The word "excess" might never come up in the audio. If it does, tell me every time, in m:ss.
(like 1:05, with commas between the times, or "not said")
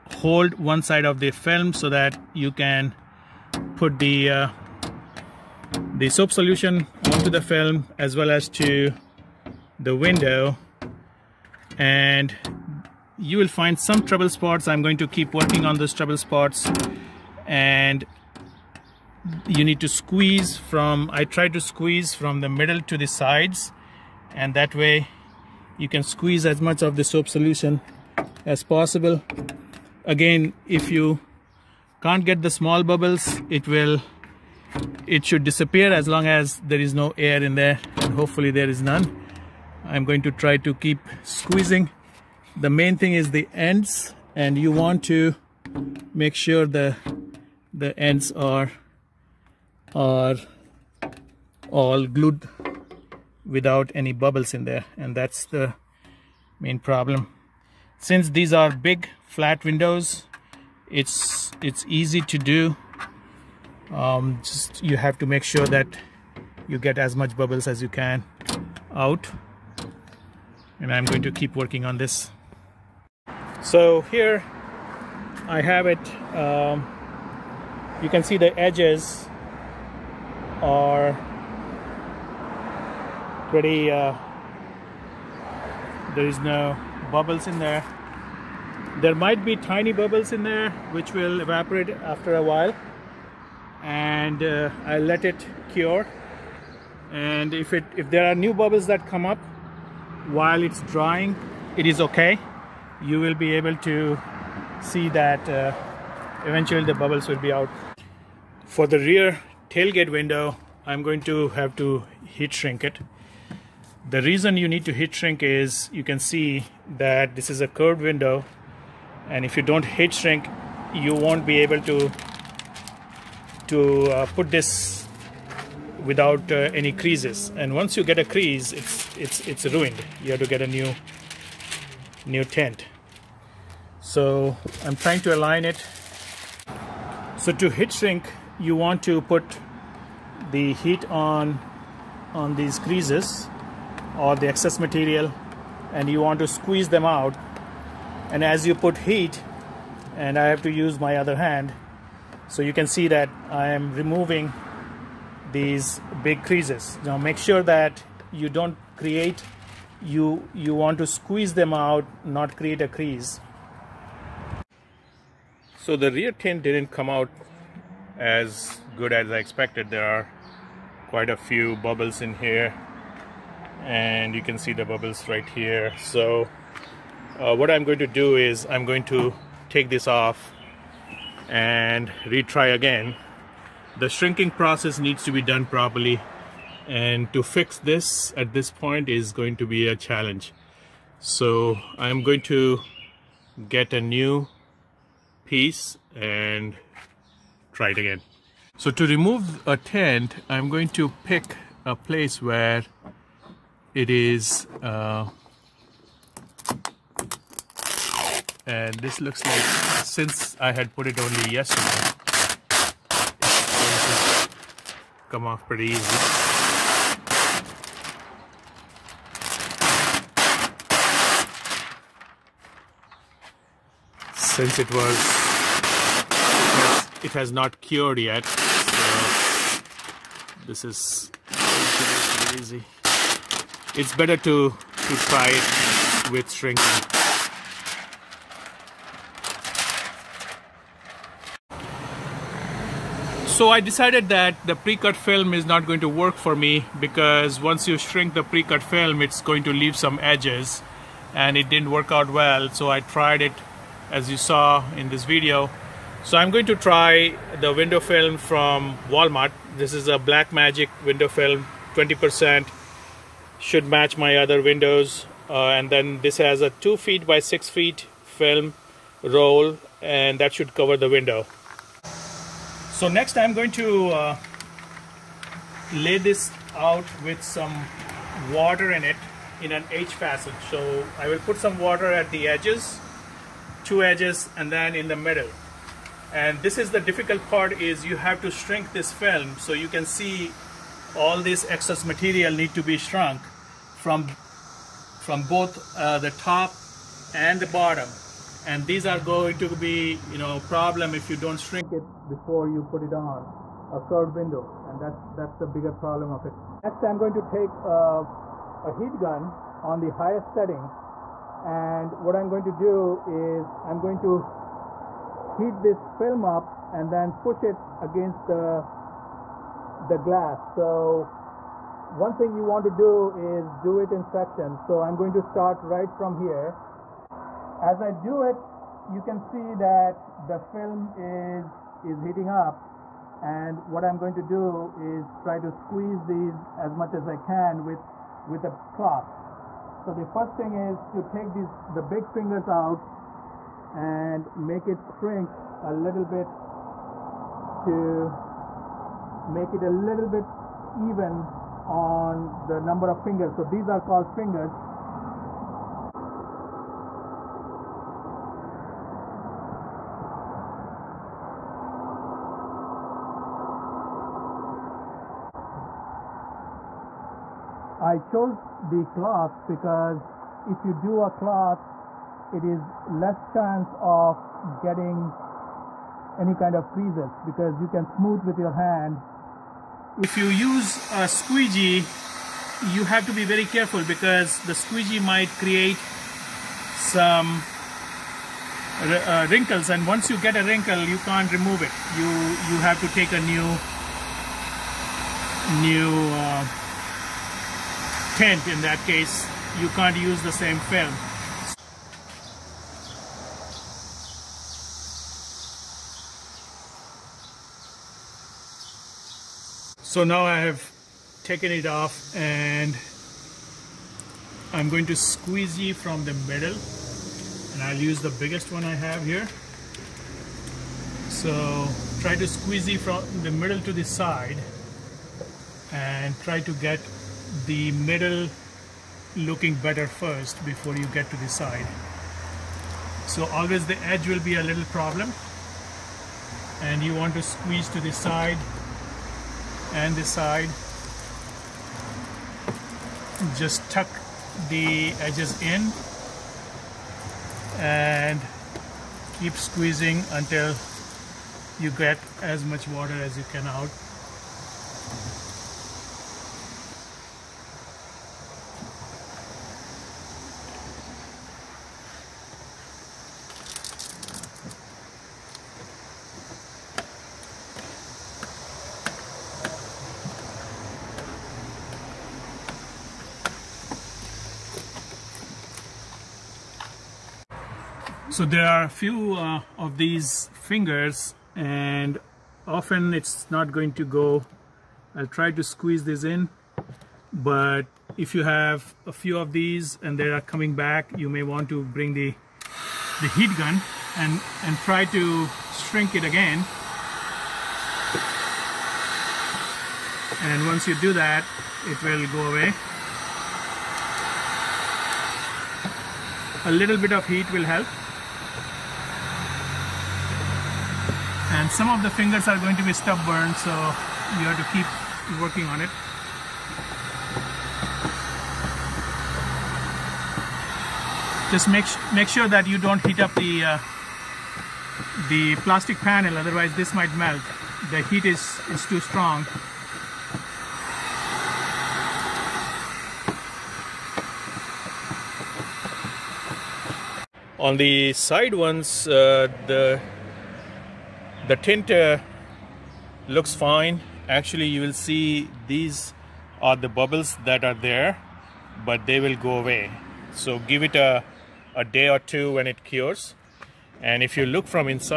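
2:24, 4:51.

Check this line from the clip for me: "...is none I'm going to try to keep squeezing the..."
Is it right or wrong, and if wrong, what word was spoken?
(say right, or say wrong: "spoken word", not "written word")
right.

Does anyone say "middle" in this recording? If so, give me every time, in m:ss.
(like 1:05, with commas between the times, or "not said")
0:22, 4:45, 6:56, 7:03, 7:07.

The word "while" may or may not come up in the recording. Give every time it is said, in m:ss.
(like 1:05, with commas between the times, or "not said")
1:32, 1:40.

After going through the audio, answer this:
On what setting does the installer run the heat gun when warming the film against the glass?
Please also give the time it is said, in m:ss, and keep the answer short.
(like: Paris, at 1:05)
Highest setting, at 5:10.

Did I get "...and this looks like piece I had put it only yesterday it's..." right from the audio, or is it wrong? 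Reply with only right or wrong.
wrong.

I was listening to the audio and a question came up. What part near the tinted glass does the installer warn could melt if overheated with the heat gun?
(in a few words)
The plastic panel.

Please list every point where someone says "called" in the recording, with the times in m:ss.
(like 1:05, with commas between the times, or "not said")
5:54.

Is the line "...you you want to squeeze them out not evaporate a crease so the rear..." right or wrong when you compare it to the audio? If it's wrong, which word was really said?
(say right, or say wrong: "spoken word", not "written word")
wrong: "create", not "evaporate".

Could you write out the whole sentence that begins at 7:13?
So always the edge will be a little problem and you want to squeeze to the side and the side.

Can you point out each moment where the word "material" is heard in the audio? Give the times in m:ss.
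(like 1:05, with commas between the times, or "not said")
2:24, 4:52.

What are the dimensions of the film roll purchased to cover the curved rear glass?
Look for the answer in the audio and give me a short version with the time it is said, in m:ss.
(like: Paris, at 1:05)
2 feet by 6 feet, at 4:26.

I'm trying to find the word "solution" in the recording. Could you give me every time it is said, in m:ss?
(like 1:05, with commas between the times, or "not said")
0:06, 0:27.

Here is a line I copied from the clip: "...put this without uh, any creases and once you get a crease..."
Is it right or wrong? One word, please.
right.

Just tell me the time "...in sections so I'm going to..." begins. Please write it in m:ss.
5:24.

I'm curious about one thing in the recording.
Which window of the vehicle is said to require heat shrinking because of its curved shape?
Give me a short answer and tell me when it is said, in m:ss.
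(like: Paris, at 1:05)
Rear tailgate window, at 1:48.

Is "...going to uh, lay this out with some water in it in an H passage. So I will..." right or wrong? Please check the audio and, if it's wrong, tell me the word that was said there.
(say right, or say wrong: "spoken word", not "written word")
right.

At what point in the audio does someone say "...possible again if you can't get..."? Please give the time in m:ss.
0:28.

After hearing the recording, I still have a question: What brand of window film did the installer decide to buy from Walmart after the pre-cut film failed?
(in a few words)
Black Magic.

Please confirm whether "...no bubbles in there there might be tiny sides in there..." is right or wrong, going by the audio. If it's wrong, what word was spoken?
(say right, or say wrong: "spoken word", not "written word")
wrong: "bubbles", not "sides".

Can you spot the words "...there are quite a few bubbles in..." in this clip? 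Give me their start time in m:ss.
2:49.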